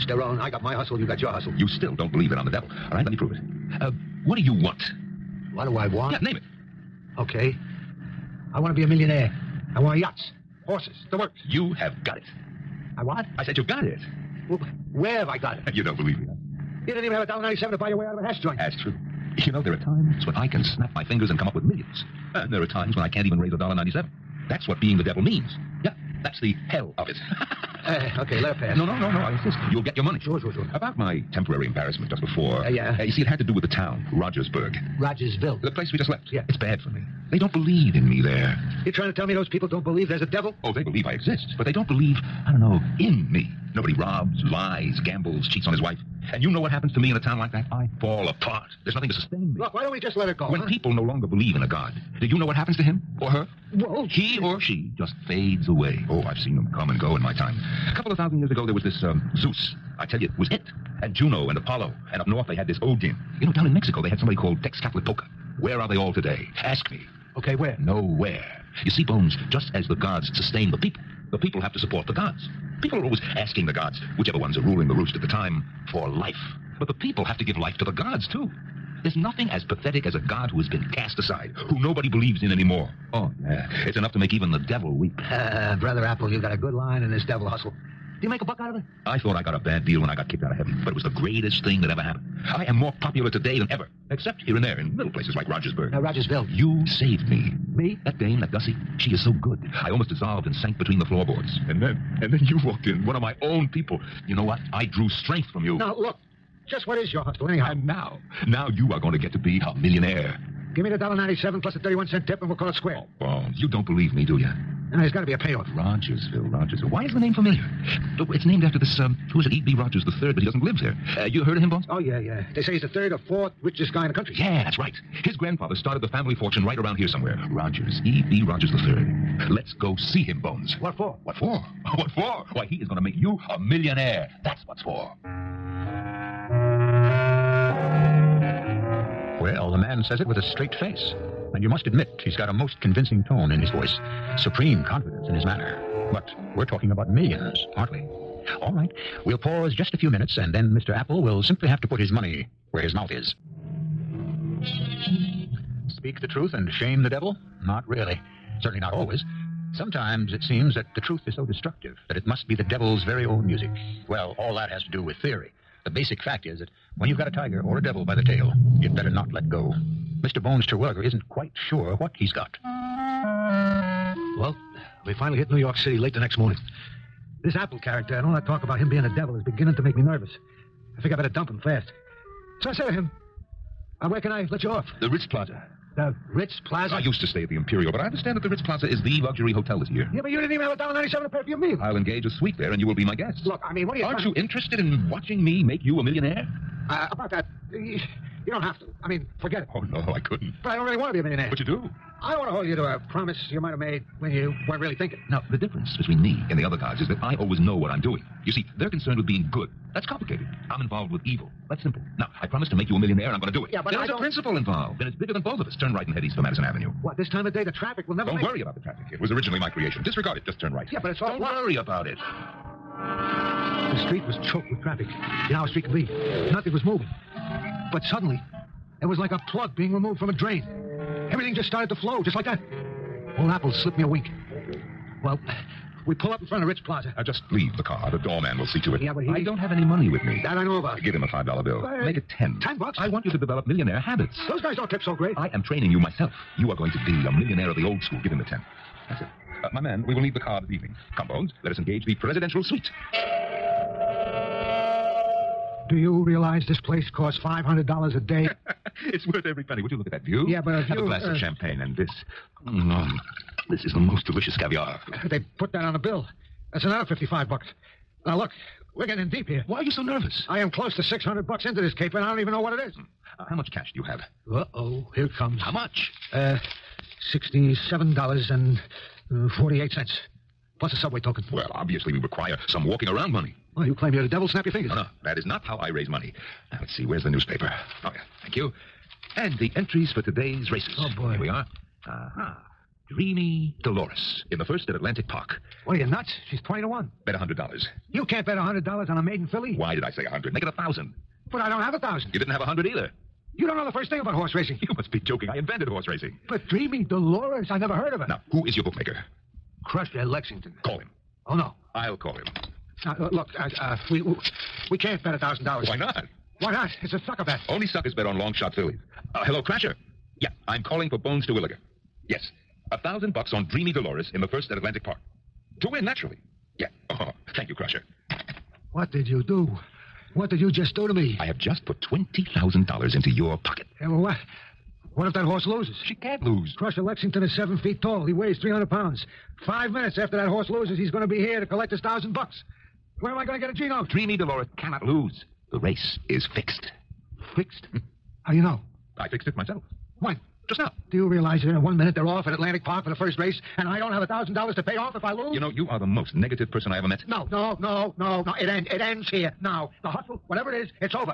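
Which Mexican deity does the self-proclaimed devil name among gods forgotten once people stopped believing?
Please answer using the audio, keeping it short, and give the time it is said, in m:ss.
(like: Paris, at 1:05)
Tezcatlipoca, at 1:04.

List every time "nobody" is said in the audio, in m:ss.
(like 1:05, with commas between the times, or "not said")
0:43, 1:21.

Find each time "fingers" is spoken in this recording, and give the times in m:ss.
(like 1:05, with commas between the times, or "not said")
0:21, 4:44.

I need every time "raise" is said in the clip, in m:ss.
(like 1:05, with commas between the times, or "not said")
0:23, 4:45.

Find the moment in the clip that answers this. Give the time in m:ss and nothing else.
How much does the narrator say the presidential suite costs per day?
4:17.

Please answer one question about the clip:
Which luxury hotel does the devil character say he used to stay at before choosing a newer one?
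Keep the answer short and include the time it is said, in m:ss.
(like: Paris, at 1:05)
The Imperial, at 3:07.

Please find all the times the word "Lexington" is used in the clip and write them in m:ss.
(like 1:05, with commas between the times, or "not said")
5:10, 5:37.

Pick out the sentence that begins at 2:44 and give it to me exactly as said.
Well, all that has to do with theory.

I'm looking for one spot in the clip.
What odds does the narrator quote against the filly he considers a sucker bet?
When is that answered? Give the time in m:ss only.
4:56.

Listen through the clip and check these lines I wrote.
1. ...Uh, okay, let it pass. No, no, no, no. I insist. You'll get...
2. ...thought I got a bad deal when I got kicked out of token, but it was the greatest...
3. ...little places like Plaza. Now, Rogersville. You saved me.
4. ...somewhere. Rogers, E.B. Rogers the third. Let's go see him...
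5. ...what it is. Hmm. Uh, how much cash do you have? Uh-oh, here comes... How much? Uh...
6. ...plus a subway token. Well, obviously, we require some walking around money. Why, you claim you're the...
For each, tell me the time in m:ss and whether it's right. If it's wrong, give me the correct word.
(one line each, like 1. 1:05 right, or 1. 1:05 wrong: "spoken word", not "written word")
1. 0:27 right
2. 1:29 wrong: "heaven", not "token"
3. 1:34 wrong: "Rogersburg", not "Plaza"
4. 2:07 right
5. 4:32 right
6. 4:40 right.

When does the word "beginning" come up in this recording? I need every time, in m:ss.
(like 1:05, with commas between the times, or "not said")
2:59.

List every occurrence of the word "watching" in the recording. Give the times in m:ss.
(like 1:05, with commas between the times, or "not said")
3:15.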